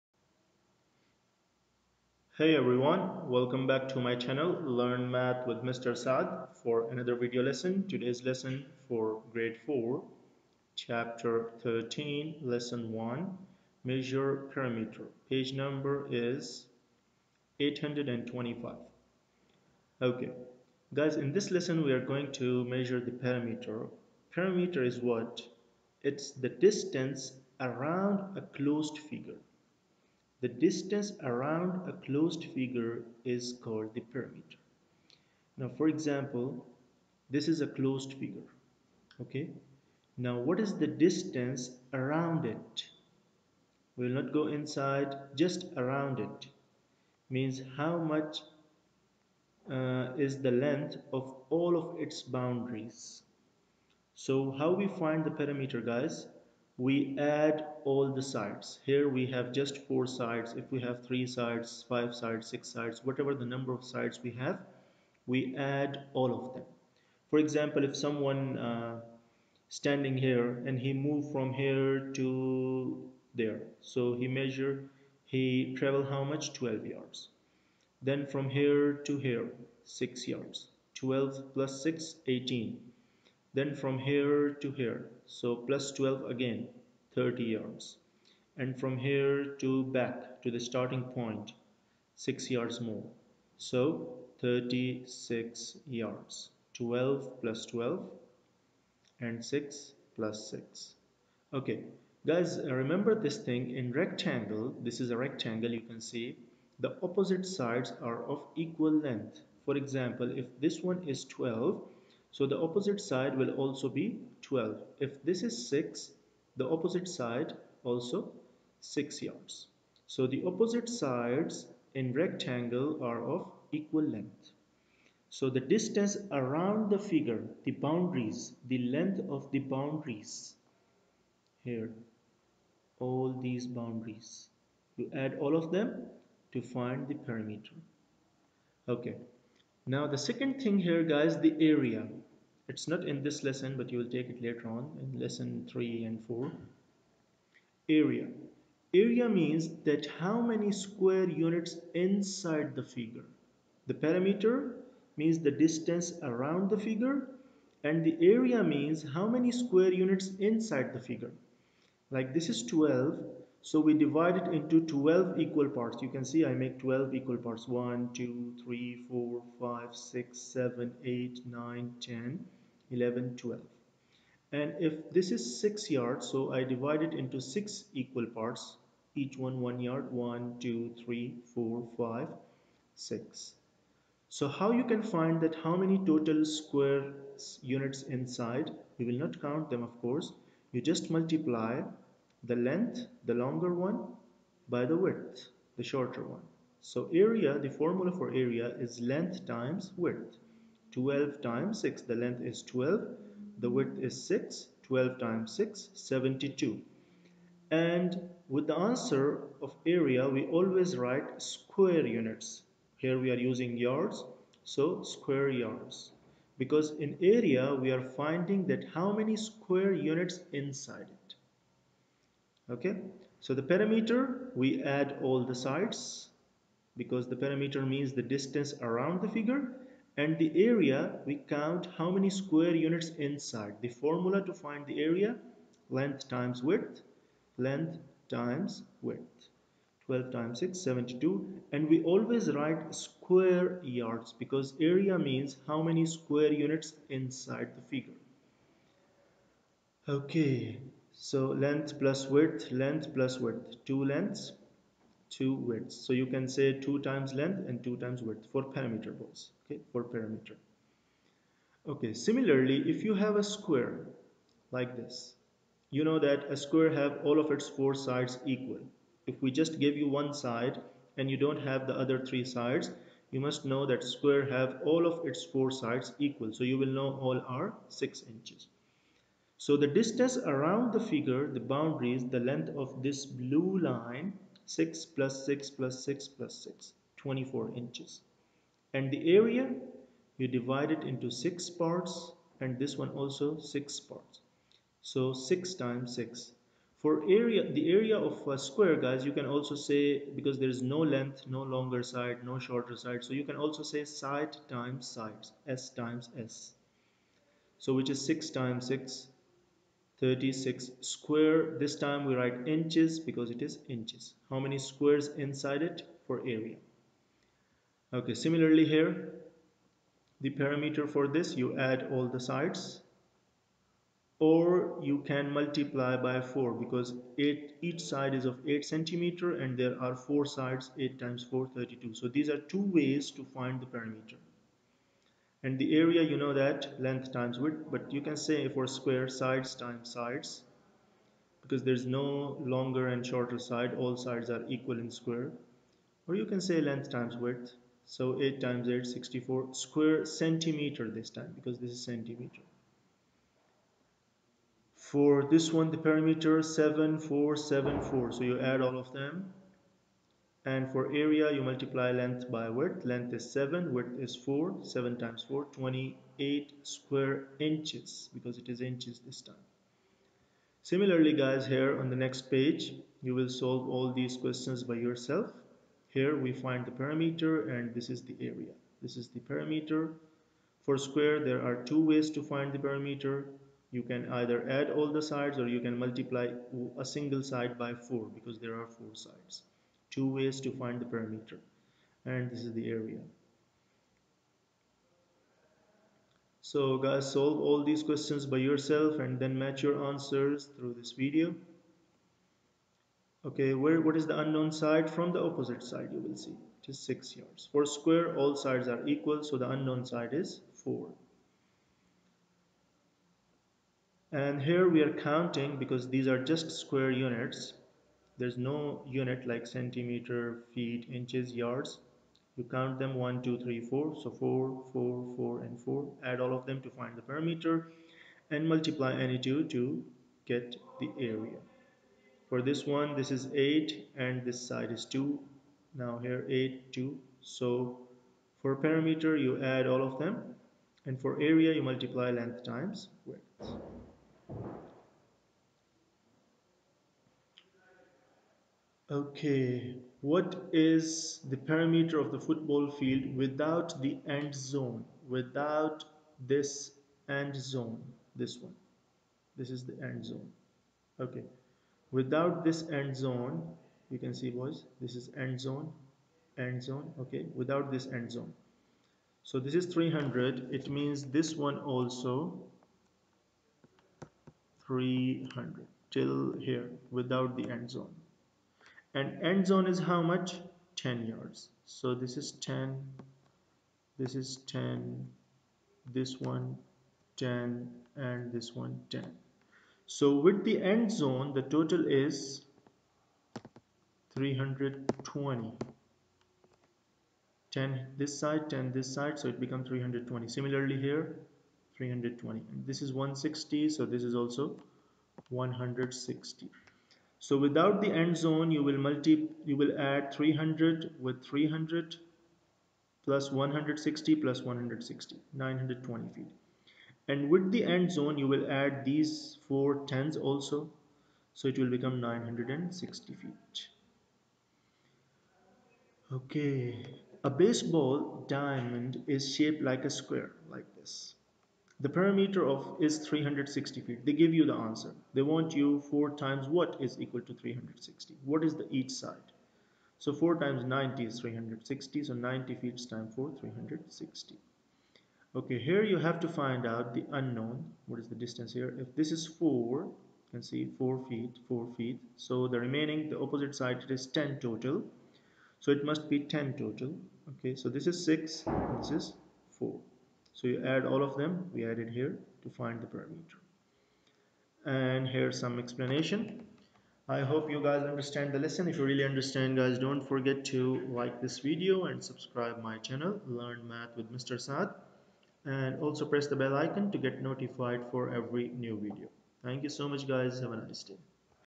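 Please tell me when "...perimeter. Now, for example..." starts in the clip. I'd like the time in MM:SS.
00:34.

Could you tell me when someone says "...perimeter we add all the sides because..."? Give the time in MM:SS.
03:43.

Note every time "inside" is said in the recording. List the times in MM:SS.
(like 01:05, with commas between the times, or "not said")
00:44, 02:32, 02:40, 03:08, 03:40, 03:53, 04:07, 05:15.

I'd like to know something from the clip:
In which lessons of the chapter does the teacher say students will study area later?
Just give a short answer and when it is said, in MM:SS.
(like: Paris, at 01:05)
lesson 3 and 4, at 02:25.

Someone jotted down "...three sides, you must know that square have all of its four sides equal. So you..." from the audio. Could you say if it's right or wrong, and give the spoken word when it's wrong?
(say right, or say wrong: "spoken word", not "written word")
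right.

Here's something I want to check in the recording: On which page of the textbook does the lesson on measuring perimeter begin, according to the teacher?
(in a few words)
825.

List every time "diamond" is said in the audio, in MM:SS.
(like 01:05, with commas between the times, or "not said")
08:48.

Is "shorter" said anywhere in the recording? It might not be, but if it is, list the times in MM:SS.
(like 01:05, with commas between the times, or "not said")
03:15, 05:02, 05:43.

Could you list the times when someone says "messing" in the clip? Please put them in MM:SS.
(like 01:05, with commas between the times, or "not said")
not said.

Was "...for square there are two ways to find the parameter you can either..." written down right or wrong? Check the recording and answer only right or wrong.
right.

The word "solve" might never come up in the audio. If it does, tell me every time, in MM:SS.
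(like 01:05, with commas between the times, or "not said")
06:13, 06:37.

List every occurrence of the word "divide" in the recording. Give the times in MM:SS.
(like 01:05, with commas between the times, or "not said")
02:44, 02:56, 04:50.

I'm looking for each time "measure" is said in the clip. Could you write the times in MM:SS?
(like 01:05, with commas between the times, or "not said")
00:13, 00:22, 01:14.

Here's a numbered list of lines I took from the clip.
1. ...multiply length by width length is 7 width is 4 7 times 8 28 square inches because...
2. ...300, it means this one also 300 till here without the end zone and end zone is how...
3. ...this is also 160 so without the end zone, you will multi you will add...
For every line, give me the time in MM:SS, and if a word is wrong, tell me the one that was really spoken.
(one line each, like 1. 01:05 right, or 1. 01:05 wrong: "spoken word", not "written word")
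1. 06:01 wrong: "4", not "8"
2. 07:49 right
3. 08:24 right.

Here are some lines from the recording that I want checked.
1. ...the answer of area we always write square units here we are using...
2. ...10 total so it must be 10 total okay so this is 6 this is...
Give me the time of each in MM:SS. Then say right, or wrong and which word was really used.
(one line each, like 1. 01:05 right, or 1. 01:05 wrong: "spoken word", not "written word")
1. 03:28 right
2. 09:14 right.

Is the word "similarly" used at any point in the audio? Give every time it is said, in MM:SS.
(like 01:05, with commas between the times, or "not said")
04:22, 05:18, 06:10, 08:20.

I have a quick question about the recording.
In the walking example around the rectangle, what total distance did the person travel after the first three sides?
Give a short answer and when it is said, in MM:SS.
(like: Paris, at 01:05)
30 yards, at 01:27.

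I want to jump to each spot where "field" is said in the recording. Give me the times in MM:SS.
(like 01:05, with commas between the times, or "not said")
07:32.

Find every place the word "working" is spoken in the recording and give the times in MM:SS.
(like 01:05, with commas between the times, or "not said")
not said.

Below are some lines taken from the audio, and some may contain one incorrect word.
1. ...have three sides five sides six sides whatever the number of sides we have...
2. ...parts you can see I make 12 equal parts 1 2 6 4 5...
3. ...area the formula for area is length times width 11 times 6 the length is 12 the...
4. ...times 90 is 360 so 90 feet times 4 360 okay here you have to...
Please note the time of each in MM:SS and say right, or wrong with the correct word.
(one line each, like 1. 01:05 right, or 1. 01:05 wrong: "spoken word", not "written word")
1. 01:00 right
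2. 02:45 wrong: "3", not "6"
3. 03:17 wrong: "12", not "11"
4. 09:00 right.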